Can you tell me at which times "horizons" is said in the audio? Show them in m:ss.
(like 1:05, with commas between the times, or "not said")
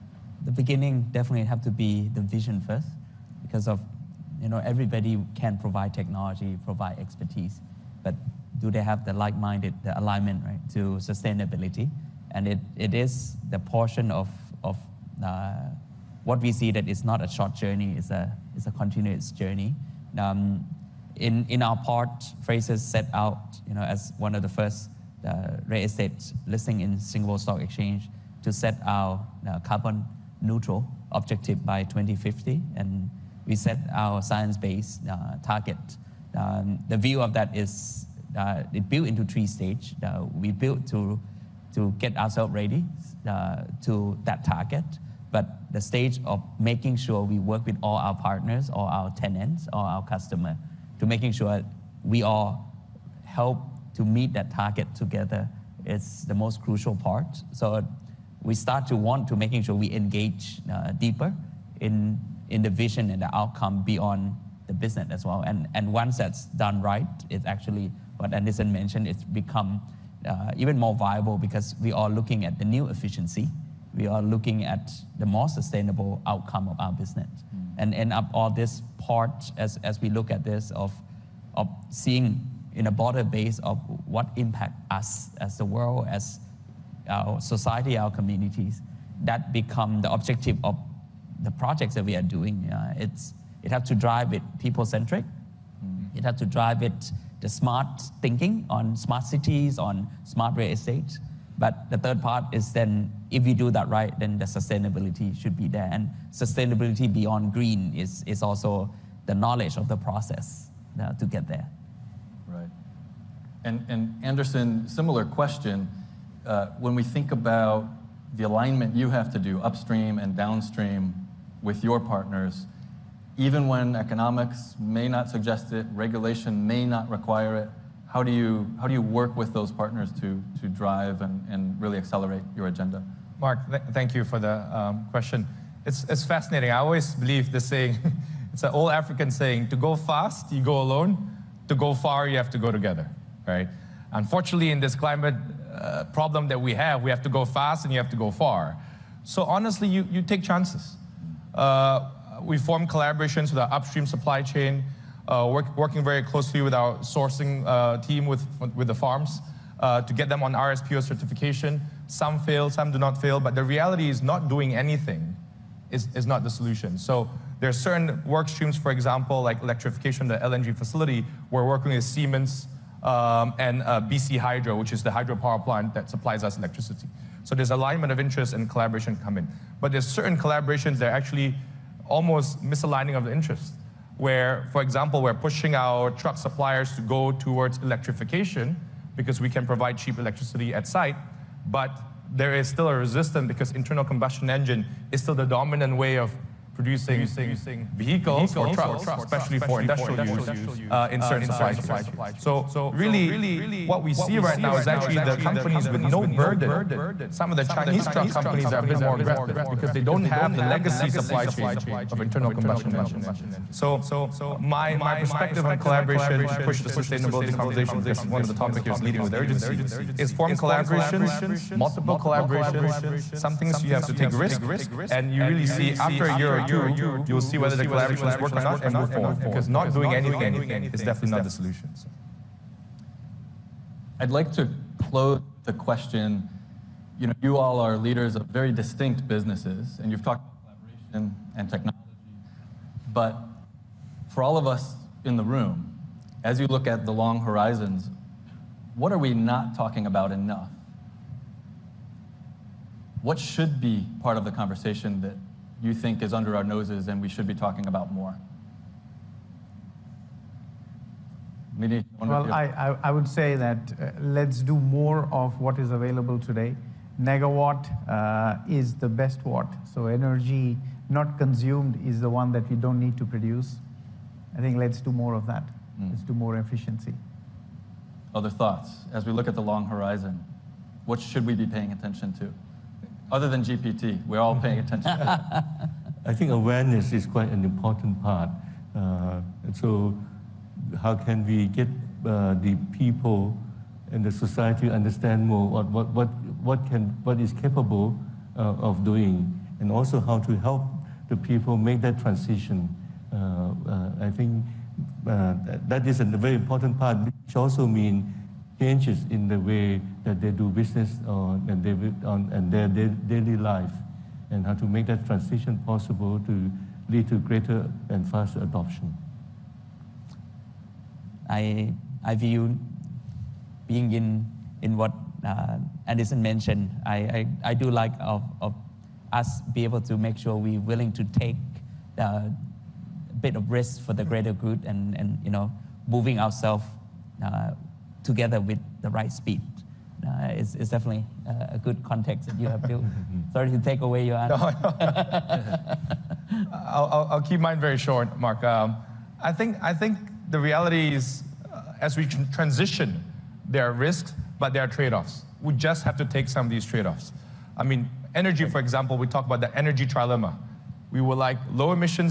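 4:07, 4:39.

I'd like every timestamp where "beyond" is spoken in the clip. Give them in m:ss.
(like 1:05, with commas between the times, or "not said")
1:03, 1:47.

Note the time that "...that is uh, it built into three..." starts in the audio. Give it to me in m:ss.
0:37.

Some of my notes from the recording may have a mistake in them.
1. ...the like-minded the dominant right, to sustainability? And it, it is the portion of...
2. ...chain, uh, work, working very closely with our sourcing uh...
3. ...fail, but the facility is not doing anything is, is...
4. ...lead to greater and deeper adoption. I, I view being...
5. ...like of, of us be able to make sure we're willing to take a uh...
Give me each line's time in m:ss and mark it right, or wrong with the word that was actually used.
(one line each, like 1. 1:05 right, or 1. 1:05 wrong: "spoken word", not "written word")
1. 0:09 wrong: "alignment", not "dominant"
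2. 2:34 right
3. 2:43 wrong: "reality", not "facility"
4. 5:17 wrong: "faster", not "deeper"
5. 5:27 right.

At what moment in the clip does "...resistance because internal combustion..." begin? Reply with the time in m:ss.
3:12.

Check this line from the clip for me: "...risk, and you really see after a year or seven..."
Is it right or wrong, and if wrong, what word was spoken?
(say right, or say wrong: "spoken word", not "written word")
wrong: "two", not "seven".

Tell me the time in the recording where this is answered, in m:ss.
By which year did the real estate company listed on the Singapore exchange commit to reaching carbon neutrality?
0:31.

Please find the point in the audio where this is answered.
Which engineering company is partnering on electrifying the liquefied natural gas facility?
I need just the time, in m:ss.
2:52.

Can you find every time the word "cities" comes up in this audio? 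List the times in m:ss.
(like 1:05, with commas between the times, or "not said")
1:39.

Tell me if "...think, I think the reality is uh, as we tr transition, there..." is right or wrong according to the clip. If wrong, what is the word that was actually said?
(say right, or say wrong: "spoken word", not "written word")
right.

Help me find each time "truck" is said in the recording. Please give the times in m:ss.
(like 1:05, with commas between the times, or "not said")
3:06, 3:18, 3:28.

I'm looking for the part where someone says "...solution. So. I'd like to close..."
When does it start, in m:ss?
3:51.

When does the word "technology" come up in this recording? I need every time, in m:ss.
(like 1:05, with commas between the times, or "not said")
0:05, 4:01.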